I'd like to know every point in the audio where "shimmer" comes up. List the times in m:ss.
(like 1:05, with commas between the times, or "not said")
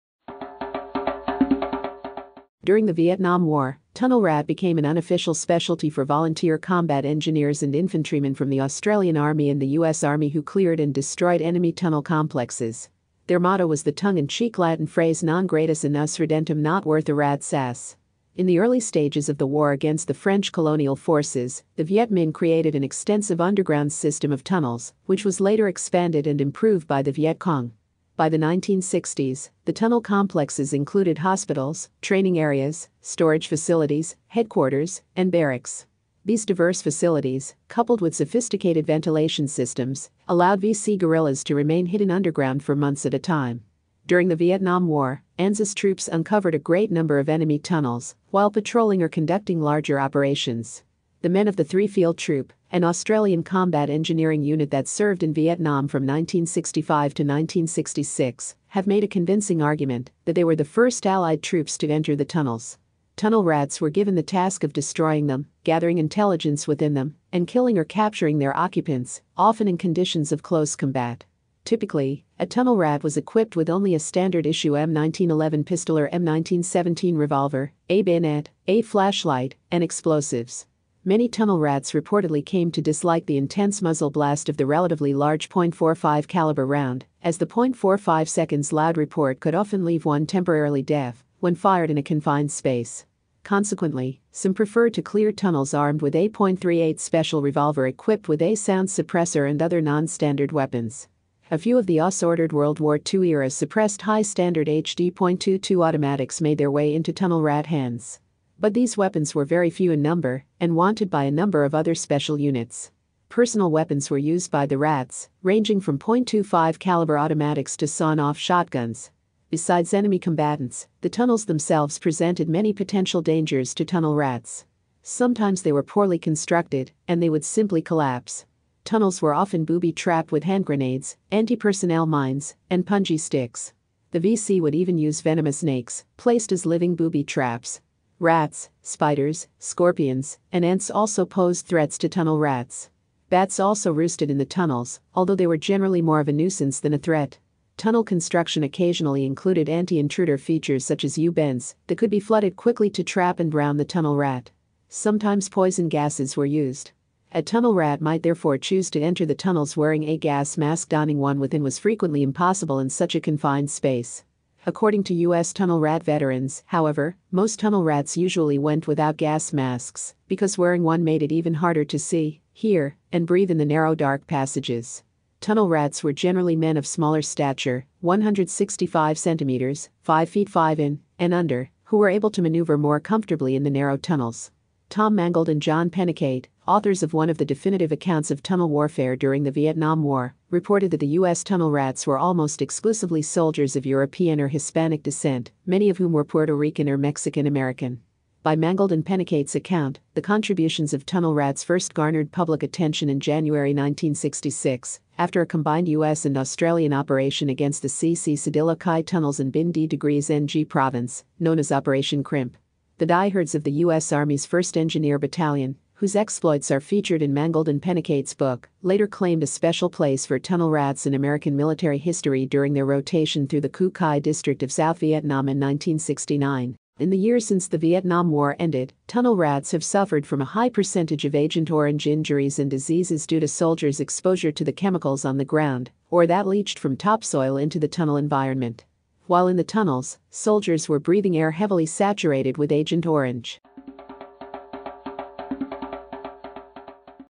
not said.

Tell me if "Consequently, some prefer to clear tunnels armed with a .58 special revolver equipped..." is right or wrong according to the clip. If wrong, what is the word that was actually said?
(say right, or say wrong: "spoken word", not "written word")
wrong: "38", not "58".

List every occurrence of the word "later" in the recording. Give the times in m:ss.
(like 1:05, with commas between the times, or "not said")
0:25, 3:38.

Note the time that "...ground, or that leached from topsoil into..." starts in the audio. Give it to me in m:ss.
3:55.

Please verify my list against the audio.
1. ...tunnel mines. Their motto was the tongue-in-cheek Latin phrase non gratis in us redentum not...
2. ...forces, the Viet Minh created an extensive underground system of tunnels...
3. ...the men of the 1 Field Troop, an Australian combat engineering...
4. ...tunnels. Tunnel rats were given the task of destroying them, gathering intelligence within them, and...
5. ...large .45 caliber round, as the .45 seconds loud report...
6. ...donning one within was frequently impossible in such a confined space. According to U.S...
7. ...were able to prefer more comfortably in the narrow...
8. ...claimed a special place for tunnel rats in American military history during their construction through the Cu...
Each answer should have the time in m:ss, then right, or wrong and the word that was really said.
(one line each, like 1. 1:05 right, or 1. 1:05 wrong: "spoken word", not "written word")
1. 0:11 wrong: "complexes", not "mines"
2. 0:20 right
3. 0:51 wrong: "3", not "1"
4. 1:02 right
5. 1:25 right
6. 2:40 right
7. 3:01 wrong: "maneuver", not "prefer"
8. 3:39 wrong: "rotation", not "construction".